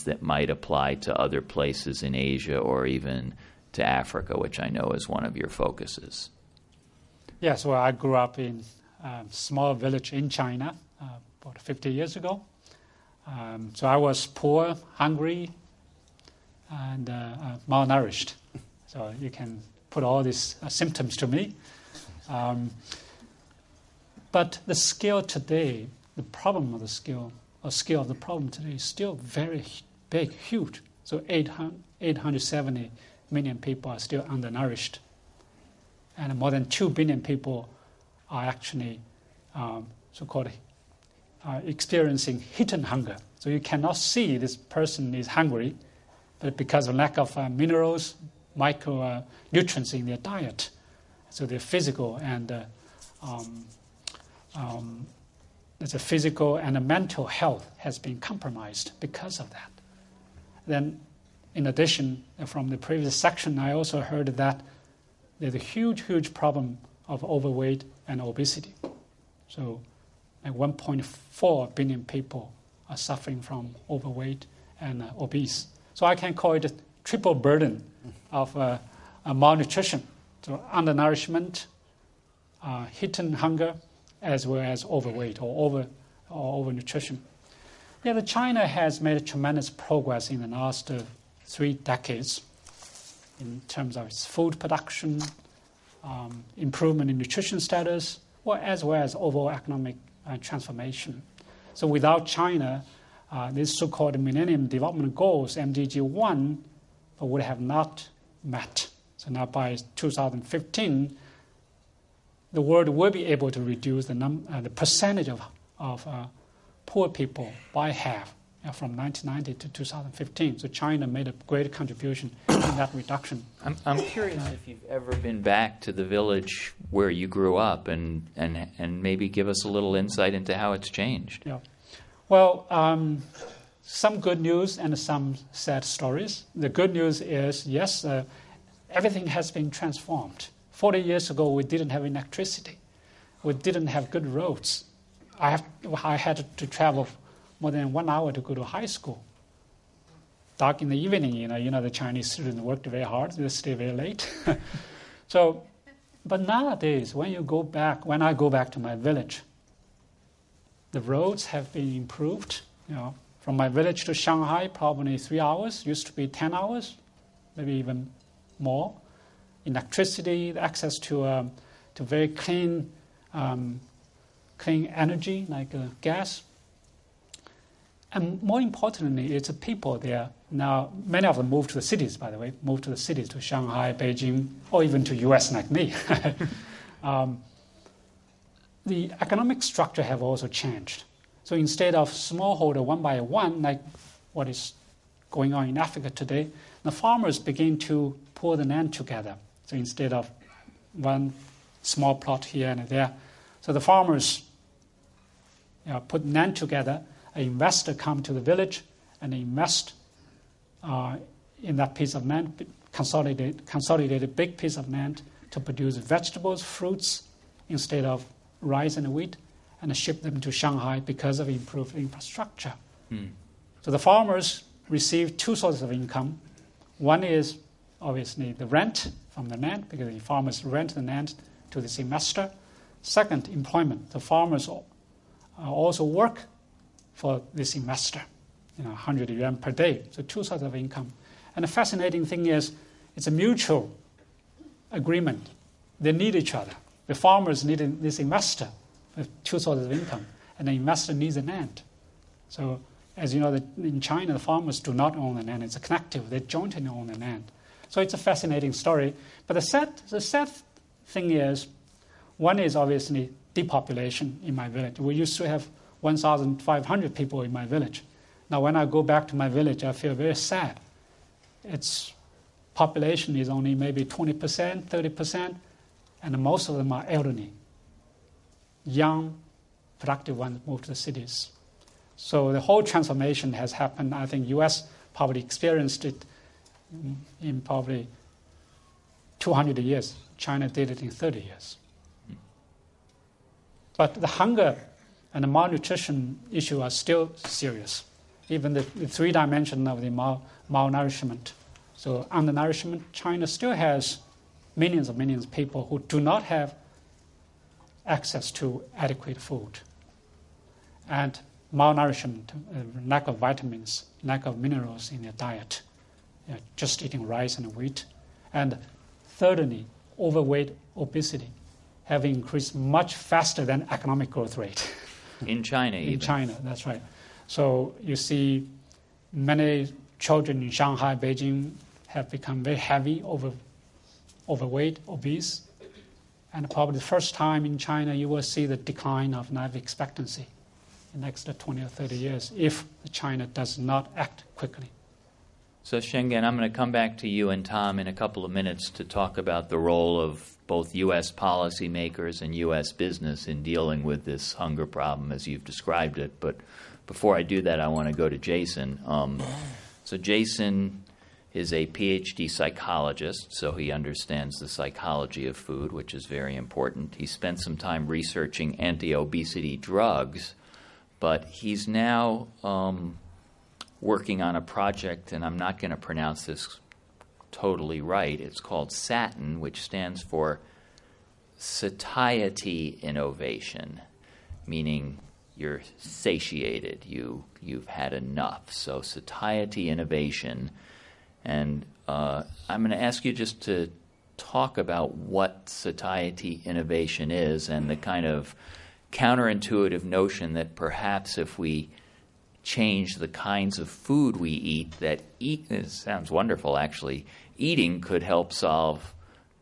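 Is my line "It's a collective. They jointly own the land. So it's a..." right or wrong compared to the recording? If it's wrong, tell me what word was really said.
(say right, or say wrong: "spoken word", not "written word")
right.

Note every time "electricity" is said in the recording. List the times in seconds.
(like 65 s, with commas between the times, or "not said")
142 s, 169 s.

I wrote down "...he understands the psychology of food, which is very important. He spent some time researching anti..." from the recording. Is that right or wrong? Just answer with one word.
right.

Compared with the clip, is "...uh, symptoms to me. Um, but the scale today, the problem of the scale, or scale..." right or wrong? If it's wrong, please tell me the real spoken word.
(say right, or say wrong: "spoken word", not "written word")
right.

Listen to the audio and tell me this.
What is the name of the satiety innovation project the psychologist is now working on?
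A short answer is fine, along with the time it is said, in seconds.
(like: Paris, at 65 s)
SATIN, at 378 s.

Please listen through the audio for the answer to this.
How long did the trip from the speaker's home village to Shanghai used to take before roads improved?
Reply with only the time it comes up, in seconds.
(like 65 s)
166 s.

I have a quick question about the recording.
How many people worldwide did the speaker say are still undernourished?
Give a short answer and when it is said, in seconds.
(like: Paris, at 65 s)
870 million, at 31 s.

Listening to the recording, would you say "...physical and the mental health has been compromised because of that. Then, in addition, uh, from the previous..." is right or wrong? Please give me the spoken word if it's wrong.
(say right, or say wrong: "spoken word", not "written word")
right.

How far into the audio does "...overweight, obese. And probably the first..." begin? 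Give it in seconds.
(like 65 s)
334 s.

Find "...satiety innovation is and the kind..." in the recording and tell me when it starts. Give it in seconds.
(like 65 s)
395 s.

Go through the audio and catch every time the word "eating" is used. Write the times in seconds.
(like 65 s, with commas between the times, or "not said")
317 s, 407 s.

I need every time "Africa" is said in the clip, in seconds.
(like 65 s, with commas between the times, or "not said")
3 s, 195 s.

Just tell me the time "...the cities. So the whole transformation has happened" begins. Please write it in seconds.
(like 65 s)
280 s.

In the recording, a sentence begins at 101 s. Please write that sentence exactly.
So without China, uh, these so-called Millennium Development Goals, MDG 1, would have not met.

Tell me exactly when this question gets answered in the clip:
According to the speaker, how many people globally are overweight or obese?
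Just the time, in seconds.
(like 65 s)
70 s.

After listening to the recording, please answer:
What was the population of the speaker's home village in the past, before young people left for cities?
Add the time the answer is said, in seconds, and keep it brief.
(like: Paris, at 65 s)
1,500, at 266 s.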